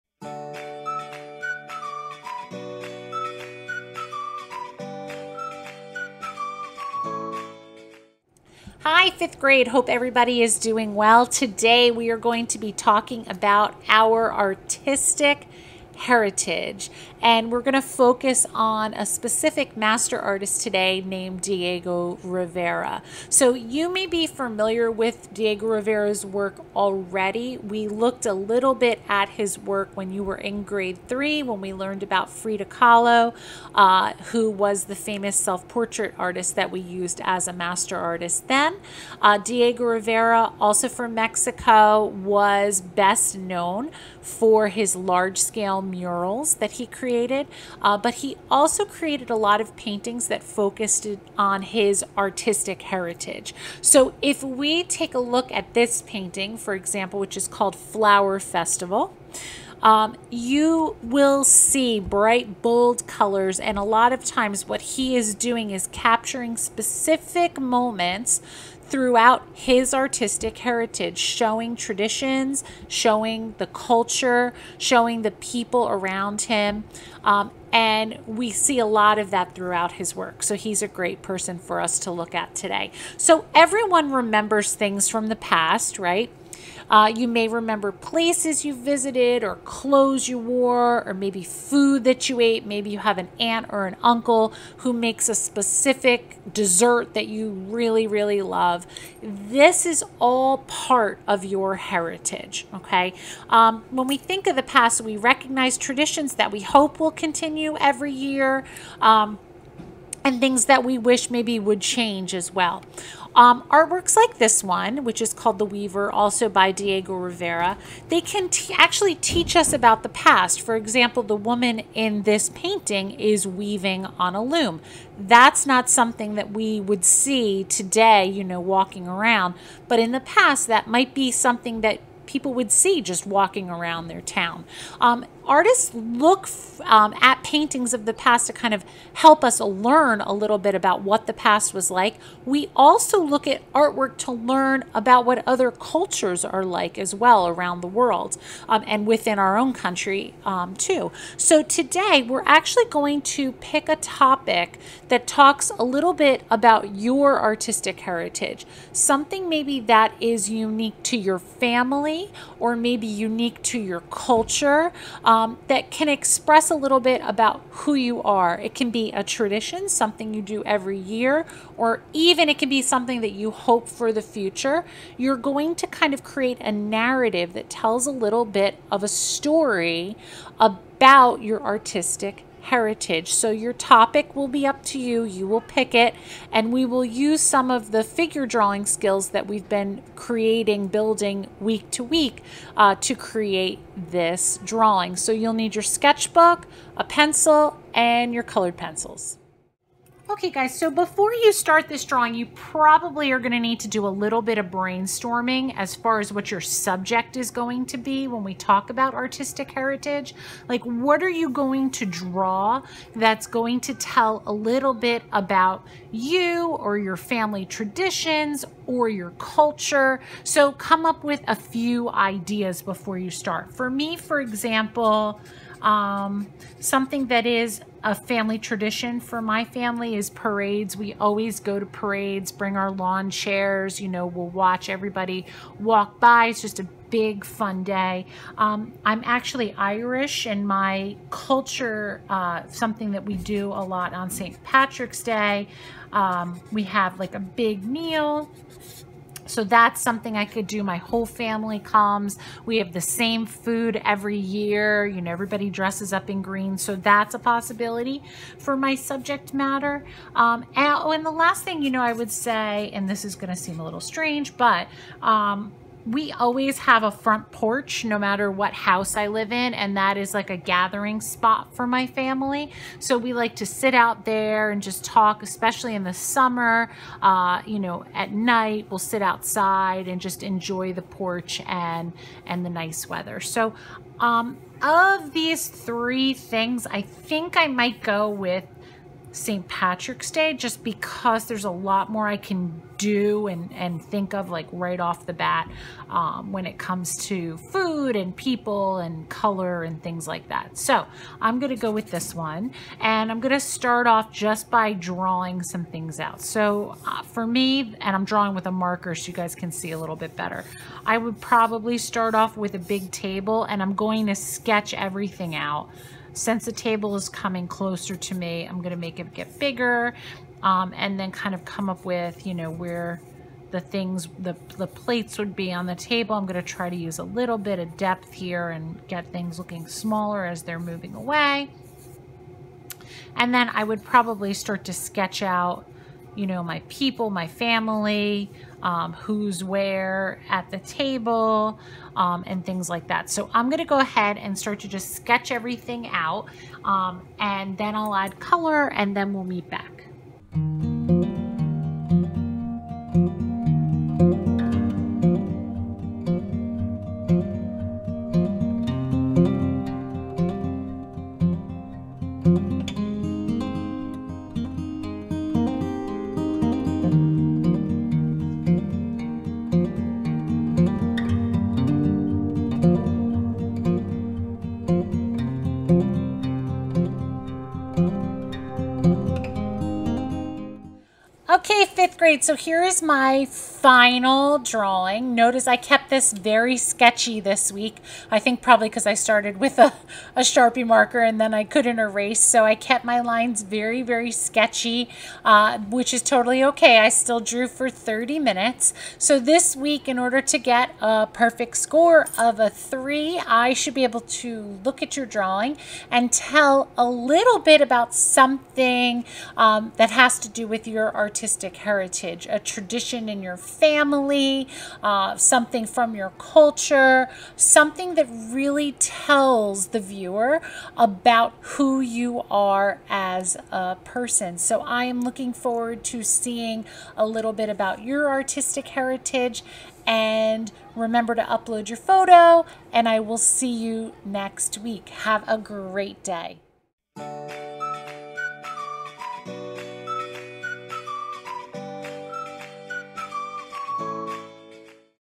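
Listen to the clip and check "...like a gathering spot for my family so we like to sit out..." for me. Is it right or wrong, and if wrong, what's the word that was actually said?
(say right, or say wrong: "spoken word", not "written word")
right.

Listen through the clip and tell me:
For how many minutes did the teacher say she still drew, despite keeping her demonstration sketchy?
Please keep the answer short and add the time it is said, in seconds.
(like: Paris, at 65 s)
30, at 397 s.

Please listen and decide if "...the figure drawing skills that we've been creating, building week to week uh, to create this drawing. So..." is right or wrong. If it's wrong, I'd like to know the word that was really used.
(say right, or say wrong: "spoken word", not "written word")
right.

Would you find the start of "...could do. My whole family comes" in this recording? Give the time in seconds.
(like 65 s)
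250 s.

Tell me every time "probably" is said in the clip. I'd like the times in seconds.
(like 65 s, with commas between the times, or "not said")
202 s, 311 s, 334 s, 388 s.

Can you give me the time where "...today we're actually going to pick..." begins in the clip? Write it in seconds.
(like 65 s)
151 s.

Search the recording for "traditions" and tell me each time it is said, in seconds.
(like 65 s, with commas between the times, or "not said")
71 s, 105 s, 169 s, 217 s, 228 s, 412 s.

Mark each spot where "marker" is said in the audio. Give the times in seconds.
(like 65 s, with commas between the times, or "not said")
308 s, 390 s.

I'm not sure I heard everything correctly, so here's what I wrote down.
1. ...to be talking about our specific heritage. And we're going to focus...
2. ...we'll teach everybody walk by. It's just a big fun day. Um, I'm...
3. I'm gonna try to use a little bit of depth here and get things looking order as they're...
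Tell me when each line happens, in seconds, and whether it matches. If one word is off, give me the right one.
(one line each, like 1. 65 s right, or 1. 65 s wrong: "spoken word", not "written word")
1. 12 s wrong: "artistic", not "specific"
2. 234 s wrong: "watch", not "teach"
3. 326 s wrong: "smaller", not "order".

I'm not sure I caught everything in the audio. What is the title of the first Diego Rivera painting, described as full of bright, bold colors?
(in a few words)
Flower Festival.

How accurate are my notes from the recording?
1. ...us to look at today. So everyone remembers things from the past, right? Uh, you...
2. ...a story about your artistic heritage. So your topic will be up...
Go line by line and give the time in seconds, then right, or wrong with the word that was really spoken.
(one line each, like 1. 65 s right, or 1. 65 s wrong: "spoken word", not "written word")
1. 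81 s right
2. 179 s right.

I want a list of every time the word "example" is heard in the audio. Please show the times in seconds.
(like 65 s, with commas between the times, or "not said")
56 s, 120 s, 224 s.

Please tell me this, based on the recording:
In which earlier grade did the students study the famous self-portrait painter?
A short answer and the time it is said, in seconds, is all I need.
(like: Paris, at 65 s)
grade 3, at 30 s.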